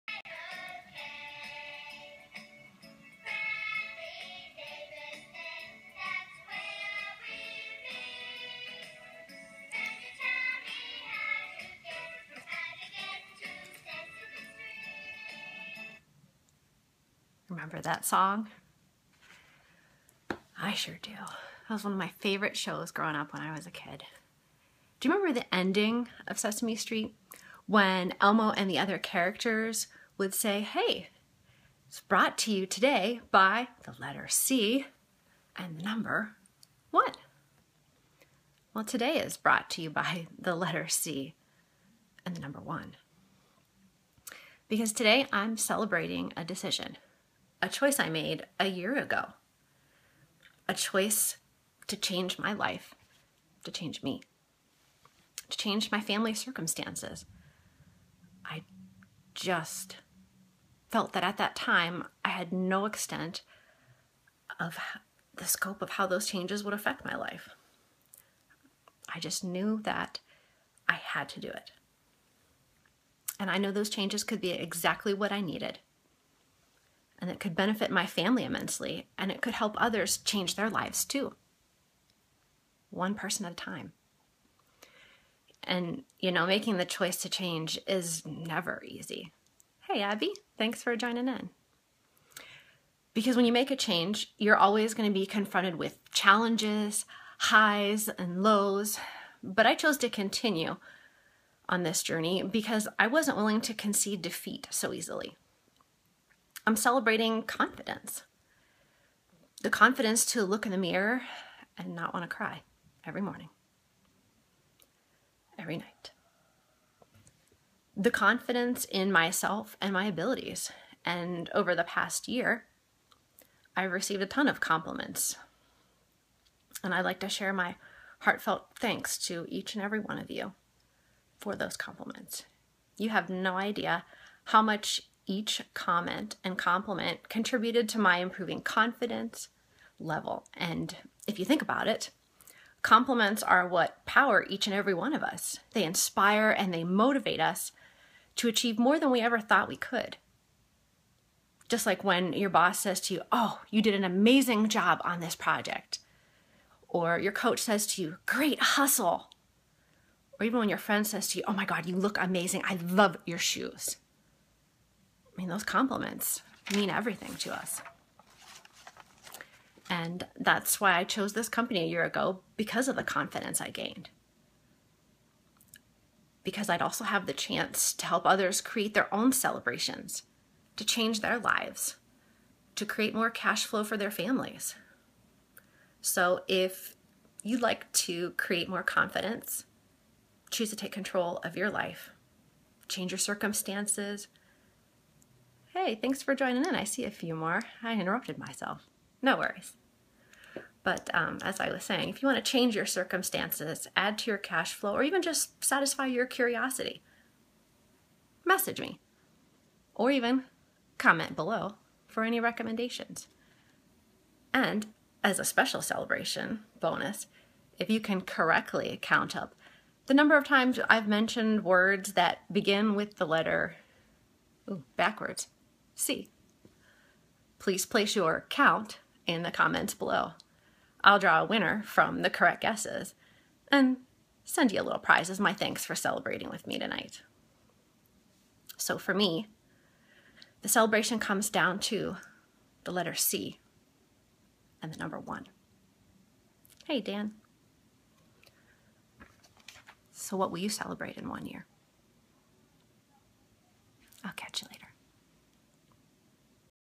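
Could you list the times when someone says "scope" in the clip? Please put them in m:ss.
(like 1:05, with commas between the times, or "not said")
1:05.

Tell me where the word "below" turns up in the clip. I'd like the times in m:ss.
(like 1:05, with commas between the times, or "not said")
3:31, 3:49.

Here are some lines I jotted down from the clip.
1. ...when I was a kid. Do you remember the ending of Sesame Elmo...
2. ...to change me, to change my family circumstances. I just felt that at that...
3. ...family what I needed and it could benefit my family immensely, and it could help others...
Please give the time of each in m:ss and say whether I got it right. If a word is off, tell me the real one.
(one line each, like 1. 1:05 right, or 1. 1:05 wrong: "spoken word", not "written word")
1. 0:23 wrong: "Street", not "Elmo"
2. 0:53 right
3. 1:14 wrong: "exactly", not "family".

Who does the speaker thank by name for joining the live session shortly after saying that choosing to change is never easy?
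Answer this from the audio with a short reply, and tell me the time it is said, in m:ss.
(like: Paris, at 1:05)
Abby, at 1:30.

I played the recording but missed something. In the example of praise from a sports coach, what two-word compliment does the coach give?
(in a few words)
Great hustle.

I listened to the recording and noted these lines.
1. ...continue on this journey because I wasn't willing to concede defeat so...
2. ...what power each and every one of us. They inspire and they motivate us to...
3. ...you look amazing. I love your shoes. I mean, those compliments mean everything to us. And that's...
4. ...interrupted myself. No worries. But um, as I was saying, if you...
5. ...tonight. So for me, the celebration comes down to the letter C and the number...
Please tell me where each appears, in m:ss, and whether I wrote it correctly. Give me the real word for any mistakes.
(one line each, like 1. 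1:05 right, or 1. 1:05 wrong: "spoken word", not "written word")
1. 1:40 right
2. 2:23 right
3. 2:41 right
4. 3:17 right
5. 3:56 right.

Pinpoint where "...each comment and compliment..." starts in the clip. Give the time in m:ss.
2:15.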